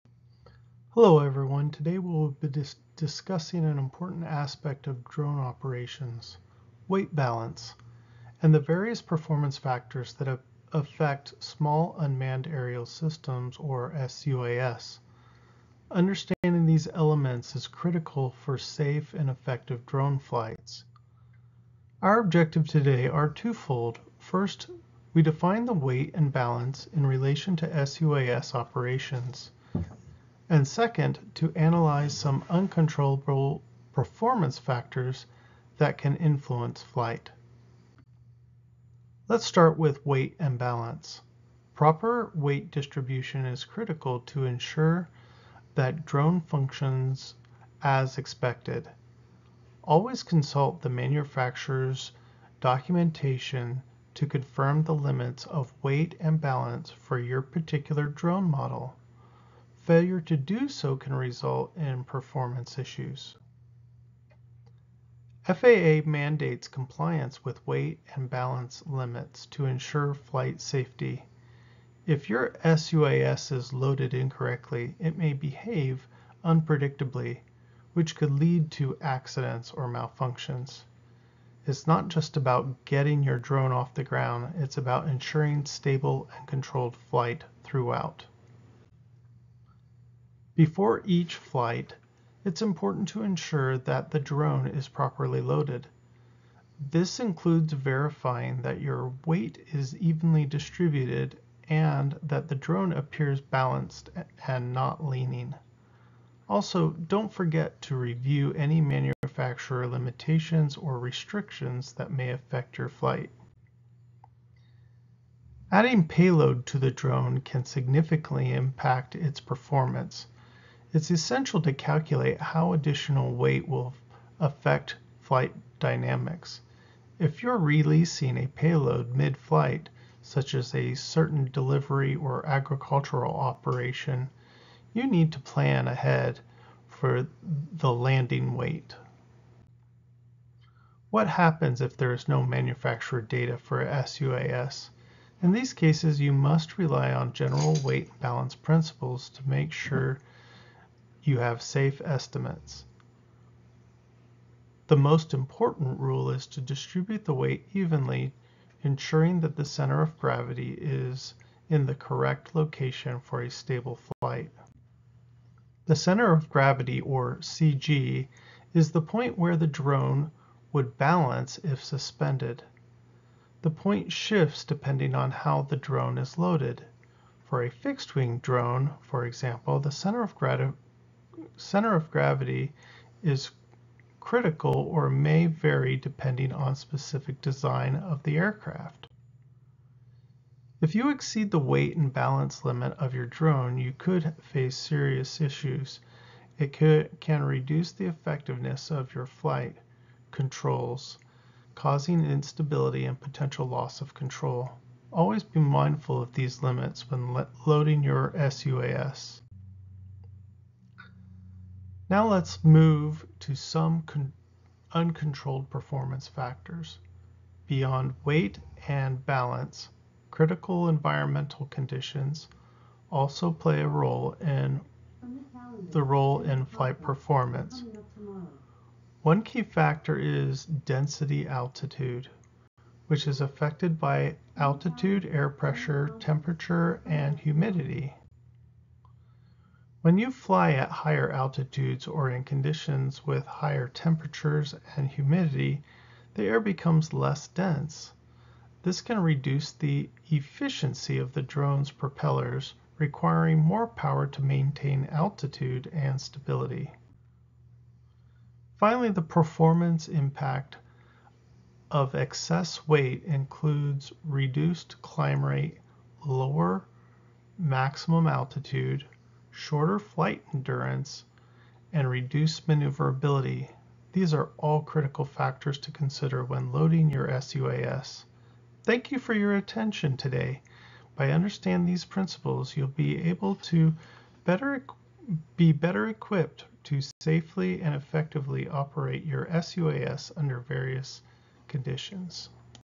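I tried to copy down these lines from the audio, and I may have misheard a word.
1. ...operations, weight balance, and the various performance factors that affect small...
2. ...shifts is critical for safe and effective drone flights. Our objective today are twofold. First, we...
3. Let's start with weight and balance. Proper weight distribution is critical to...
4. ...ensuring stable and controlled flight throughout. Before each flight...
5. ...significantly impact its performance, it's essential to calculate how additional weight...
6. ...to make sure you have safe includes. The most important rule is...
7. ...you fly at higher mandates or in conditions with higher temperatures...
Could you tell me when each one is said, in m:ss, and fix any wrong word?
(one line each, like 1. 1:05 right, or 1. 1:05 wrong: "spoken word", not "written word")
1. 0:05 right
2. 0:16 wrong: "elements", not "shifts"
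3. 0:39 right
4. 1:25 right
5. 1:57 right
6. 2:29 wrong: "estimates", not "includes"
7. 4:00 wrong: "altitudes", not "mandates".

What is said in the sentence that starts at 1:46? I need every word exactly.
Also, don't forget to review any manufacturer limitations or restrictions that may affect your flight.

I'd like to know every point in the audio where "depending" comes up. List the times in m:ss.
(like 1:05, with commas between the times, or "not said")
2:54, 3:05.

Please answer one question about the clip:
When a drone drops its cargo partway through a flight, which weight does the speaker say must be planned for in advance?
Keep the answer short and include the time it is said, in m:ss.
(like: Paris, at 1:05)
landing weight, at 2:17.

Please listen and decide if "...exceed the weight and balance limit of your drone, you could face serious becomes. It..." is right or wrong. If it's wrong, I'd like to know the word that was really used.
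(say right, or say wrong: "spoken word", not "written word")
wrong: "issues", not "becomes".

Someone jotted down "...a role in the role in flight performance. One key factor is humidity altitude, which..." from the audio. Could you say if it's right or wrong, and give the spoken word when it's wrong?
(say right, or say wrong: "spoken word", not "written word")
wrong: "density", not "humidity".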